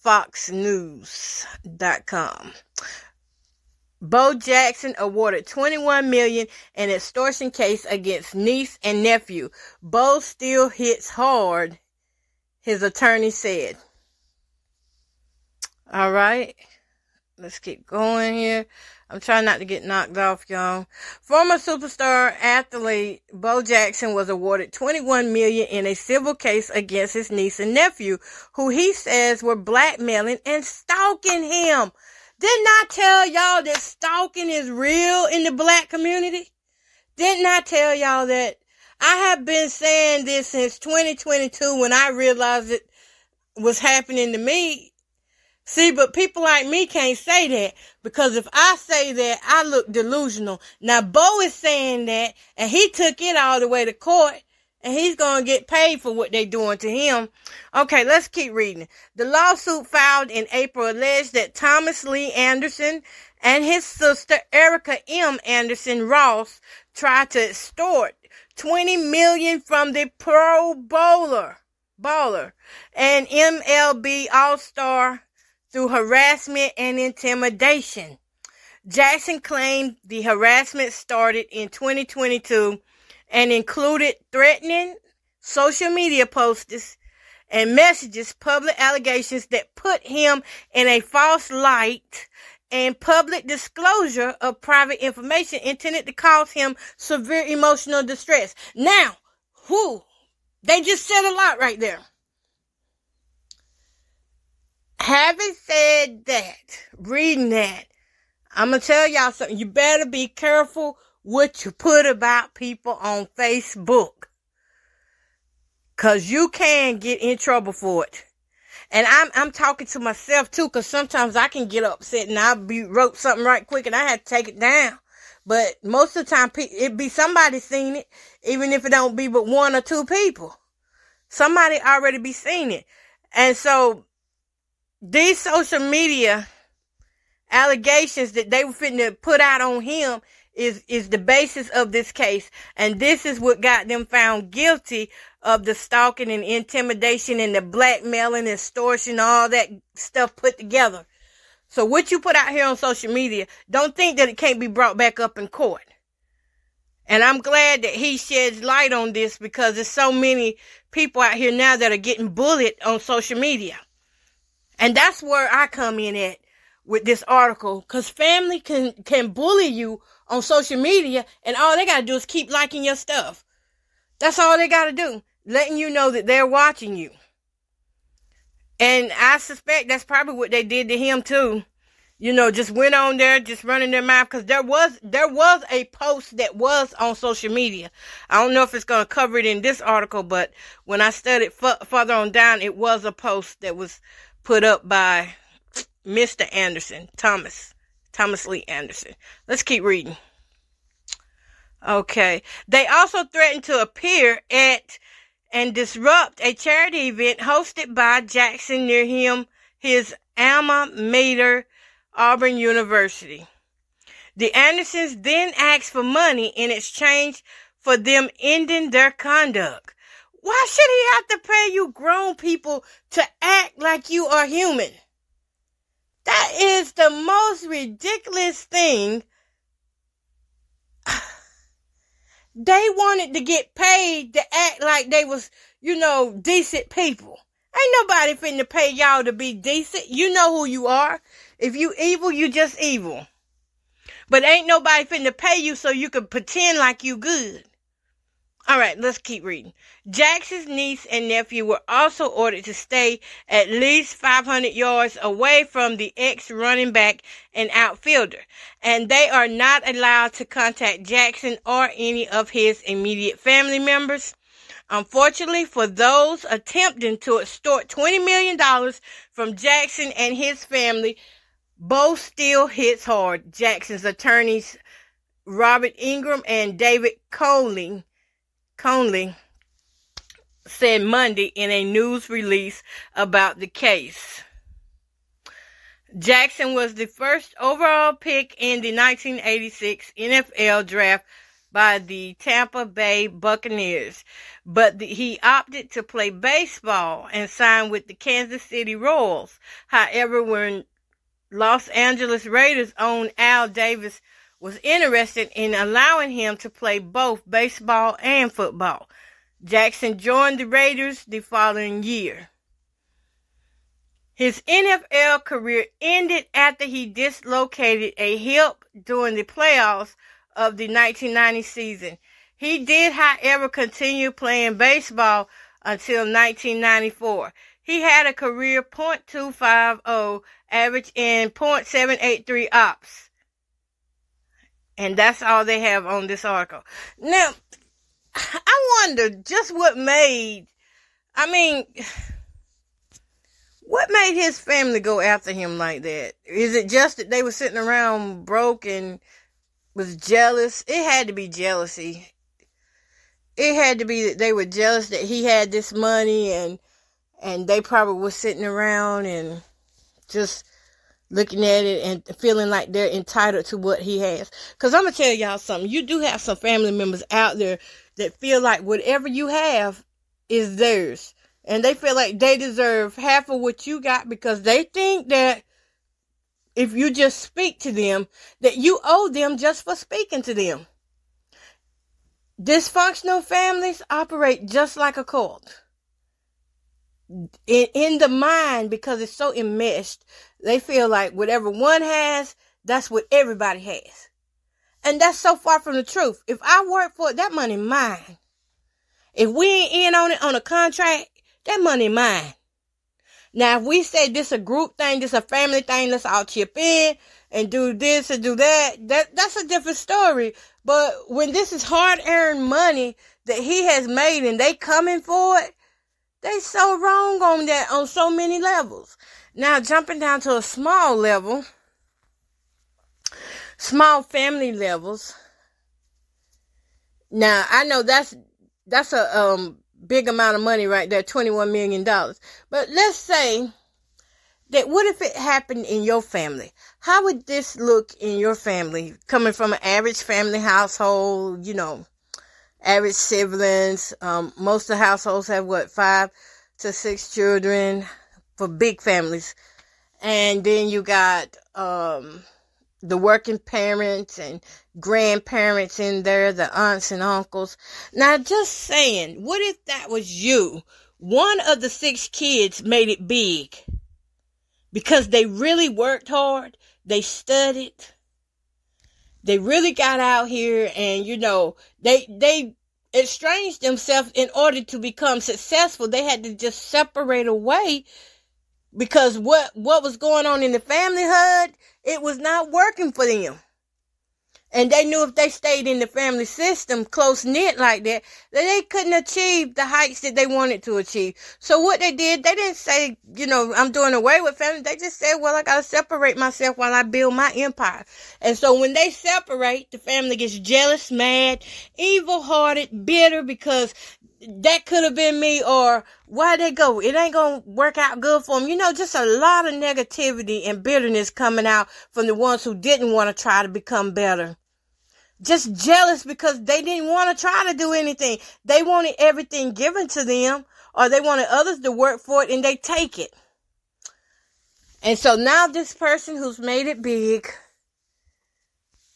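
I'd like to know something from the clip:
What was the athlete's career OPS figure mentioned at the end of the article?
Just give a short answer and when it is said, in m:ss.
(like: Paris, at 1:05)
.783, at 5:31.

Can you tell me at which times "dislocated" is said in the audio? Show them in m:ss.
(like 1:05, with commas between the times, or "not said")
5:17.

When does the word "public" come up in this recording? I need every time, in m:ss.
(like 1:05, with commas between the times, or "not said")
1:28, 1:32.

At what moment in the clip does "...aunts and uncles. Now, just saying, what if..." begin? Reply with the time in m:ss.
7:36.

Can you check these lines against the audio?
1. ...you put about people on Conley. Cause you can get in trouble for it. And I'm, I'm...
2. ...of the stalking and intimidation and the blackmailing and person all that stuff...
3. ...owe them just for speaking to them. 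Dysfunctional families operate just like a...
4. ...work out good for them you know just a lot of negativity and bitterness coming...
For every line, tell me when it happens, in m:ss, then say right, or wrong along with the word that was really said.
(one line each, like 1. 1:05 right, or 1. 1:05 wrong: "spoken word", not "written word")
1. 1:51 wrong: "Facebook", not "Conley"
2. 2:25 wrong: "extortion", not "person"
3. 6:19 right
4. 8:27 right.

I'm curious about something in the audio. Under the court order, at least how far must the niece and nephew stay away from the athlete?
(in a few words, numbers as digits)
500 yards.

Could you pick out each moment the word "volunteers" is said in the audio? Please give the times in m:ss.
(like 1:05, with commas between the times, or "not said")
not said.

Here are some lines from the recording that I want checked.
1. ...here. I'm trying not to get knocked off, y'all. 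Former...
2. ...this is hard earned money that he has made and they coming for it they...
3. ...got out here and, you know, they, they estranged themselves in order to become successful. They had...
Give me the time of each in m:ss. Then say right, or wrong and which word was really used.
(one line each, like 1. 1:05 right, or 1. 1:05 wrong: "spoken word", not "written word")
1. 0:18 right
2. 6:51 right
3. 7:49 right.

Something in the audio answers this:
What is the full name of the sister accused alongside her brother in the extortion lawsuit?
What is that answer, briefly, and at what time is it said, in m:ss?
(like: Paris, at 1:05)
Erica M. Anderson Ross, at 1:04.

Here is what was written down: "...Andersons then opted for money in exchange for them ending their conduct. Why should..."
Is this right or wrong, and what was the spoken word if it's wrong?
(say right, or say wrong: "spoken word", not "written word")
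wrong: "asked", not "opted".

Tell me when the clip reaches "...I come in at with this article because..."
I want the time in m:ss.
2:45.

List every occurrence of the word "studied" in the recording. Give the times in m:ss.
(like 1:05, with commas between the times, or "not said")
3:11, 7:47.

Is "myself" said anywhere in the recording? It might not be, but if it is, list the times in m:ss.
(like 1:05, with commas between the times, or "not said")
1:59, 8:16.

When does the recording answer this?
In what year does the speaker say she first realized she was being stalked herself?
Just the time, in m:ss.
0:40.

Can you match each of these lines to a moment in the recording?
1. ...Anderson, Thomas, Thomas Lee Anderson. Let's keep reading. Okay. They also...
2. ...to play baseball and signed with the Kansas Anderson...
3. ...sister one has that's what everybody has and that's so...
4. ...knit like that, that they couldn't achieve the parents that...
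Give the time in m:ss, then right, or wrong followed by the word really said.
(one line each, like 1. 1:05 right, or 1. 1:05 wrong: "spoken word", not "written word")
1. 3:16 right
2. 4:55 wrong: "City", not "Anderson"
3. 6:31 wrong: "whatever", not "sister"
4. 8:07 wrong: "heights", not "parents".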